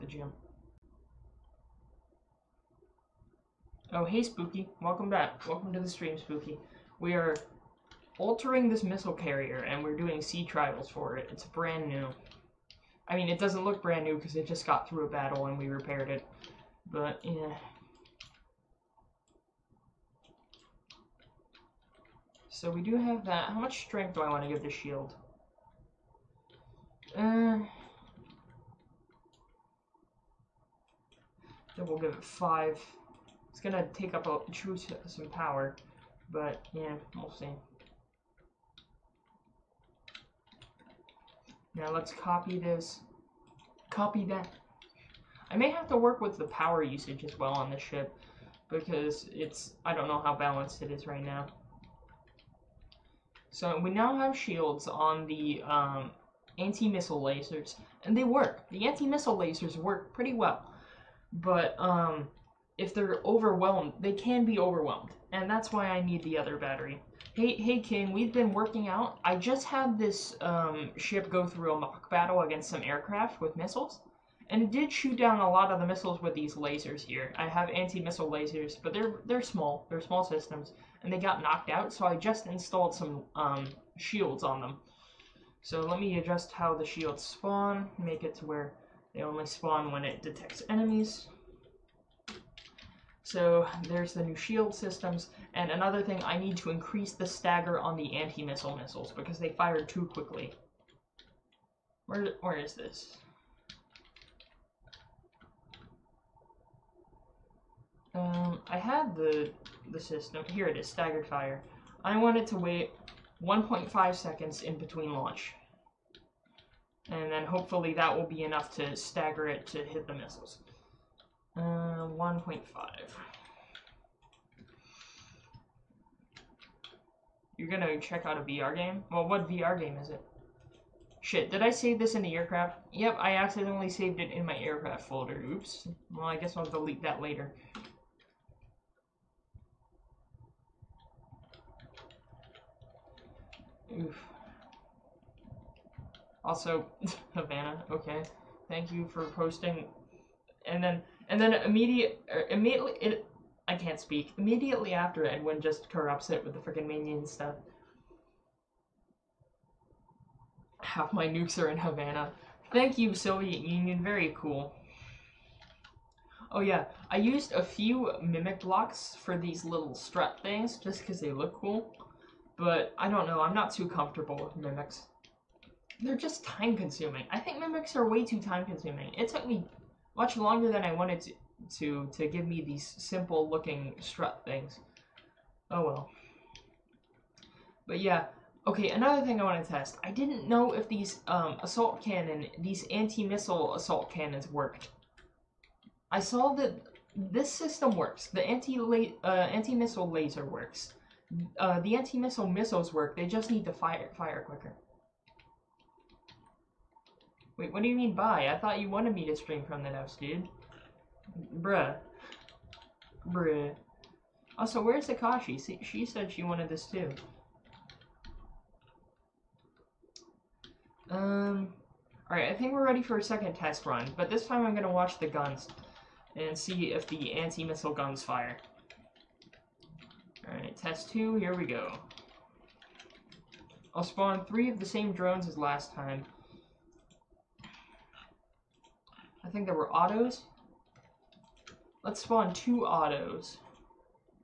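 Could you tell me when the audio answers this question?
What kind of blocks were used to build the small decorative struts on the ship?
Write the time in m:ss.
2:48.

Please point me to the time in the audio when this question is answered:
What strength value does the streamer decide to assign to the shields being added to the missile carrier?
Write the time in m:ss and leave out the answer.
0:32.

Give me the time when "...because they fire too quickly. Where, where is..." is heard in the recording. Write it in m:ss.
1:39.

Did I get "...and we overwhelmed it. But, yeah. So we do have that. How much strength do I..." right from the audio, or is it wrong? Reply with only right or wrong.
wrong.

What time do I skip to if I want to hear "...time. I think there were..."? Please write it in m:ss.
3:55.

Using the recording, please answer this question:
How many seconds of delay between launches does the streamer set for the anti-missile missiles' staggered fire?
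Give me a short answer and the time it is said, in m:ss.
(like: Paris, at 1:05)
1.5, at 1:53.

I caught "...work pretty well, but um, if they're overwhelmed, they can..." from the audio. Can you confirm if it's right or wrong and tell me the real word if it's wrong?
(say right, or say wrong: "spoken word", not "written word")
right.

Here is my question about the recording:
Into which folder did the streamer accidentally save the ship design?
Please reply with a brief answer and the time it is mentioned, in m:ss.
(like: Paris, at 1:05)
aircraft folder, at 2:14.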